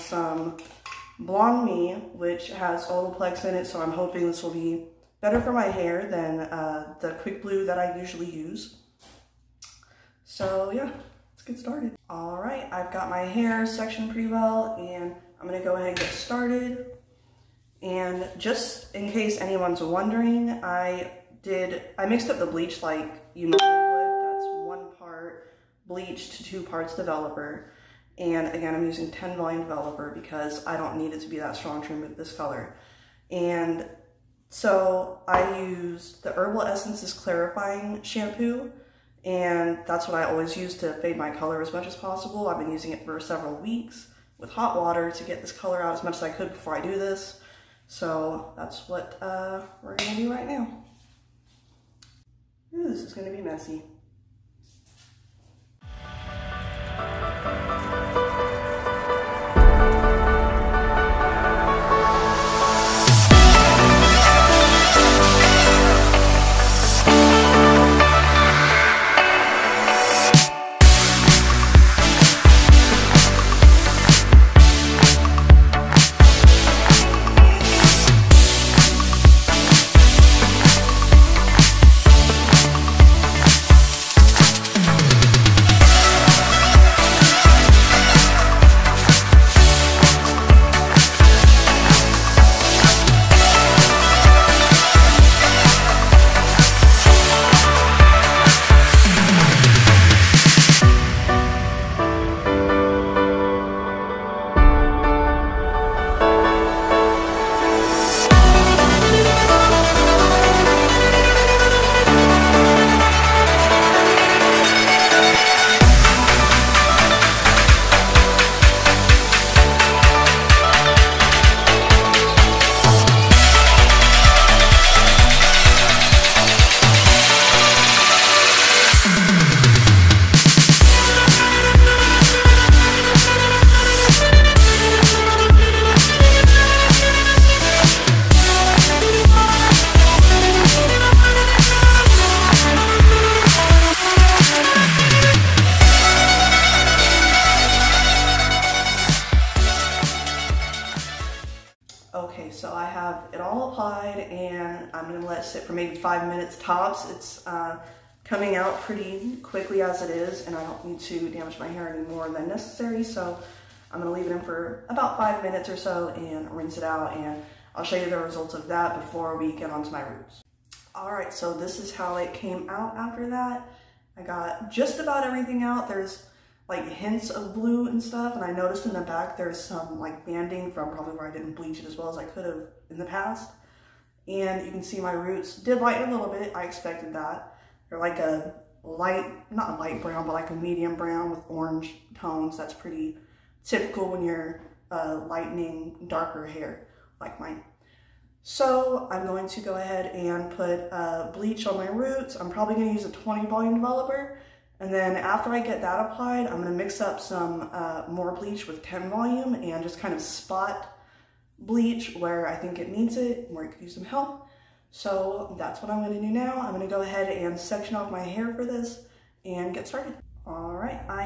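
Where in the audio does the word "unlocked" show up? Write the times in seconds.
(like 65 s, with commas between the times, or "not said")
not said.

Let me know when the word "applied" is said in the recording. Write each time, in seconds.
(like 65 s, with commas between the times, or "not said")
153 s, 206 s.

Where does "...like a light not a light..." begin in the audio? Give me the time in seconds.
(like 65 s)
187 s.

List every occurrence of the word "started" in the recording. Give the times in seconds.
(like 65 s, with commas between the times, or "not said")
11 s, 16 s, 219 s.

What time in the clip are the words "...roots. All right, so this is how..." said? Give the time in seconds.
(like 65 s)
170 s.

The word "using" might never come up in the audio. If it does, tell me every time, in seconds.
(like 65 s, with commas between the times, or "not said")
28 s, 42 s.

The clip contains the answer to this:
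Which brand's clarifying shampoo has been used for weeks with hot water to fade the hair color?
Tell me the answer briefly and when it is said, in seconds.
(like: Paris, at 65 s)
Herbal Essences, at 36 s.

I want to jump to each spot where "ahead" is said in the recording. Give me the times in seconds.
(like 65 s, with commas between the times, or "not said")
15 s, 199 s, 217 s.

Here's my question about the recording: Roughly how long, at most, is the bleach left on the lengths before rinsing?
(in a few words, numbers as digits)
5 minutes.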